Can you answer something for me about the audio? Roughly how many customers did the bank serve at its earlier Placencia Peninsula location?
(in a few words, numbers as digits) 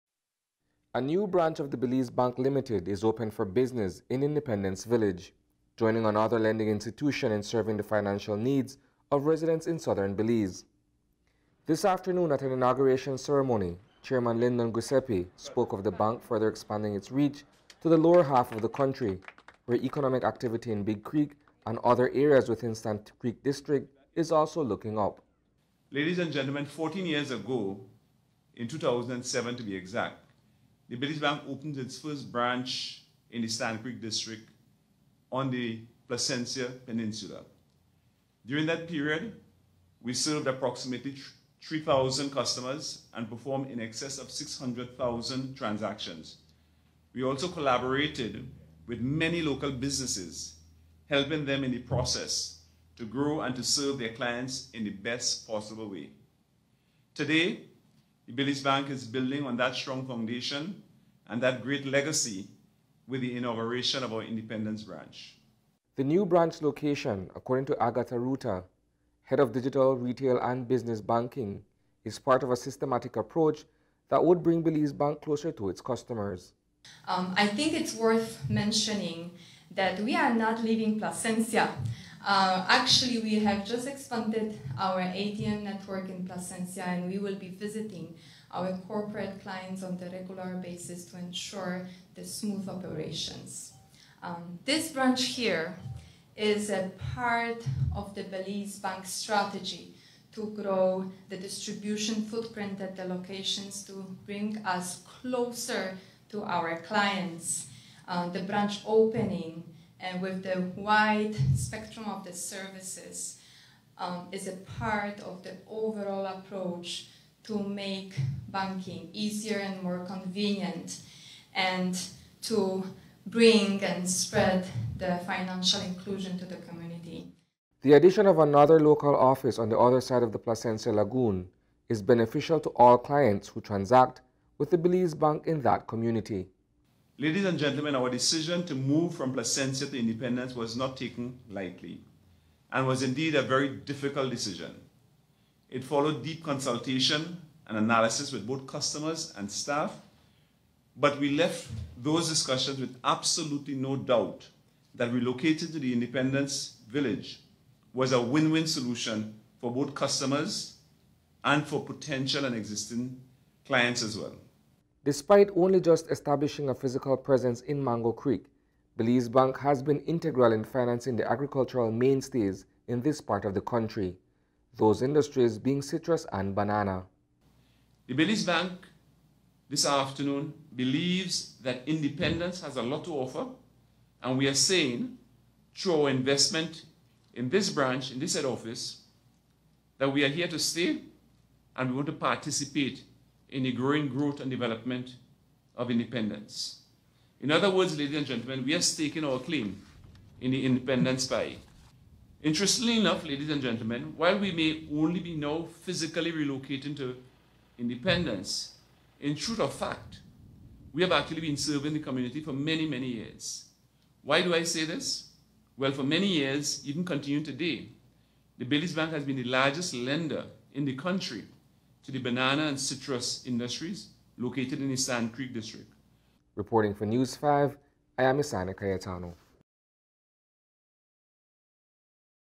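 3,000.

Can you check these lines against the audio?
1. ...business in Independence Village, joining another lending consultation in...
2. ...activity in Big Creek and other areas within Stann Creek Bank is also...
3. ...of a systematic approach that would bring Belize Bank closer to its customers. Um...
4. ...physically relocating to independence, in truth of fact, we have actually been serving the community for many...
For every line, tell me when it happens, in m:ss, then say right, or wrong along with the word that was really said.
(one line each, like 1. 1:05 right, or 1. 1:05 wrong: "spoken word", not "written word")
1. 0:03 wrong: "institution", not "consultation"
2. 0:20 wrong: "District", not "Bank"
3. 1:12 right
4. 3:25 right.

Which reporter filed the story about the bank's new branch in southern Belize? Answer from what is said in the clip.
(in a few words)
Isani Cayetano.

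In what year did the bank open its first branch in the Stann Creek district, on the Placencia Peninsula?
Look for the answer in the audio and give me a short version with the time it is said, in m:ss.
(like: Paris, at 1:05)
2007, at 0:28.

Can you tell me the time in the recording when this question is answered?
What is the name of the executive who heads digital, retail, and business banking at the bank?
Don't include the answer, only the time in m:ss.
1:07.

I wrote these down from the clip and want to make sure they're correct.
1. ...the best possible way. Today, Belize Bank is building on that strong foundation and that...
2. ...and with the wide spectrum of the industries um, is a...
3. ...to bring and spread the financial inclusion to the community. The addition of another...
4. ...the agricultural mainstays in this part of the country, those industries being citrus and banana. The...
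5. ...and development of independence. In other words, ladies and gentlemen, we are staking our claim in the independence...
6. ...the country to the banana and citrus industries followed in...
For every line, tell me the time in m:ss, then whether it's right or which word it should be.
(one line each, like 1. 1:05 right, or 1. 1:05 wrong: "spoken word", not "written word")
1. 0:54 right
2. 1:50 wrong: "services", not "industries"
3. 2:02 right
4. 2:51 right
5. 3:14 right
6. 3:40 wrong: "located", not "followed".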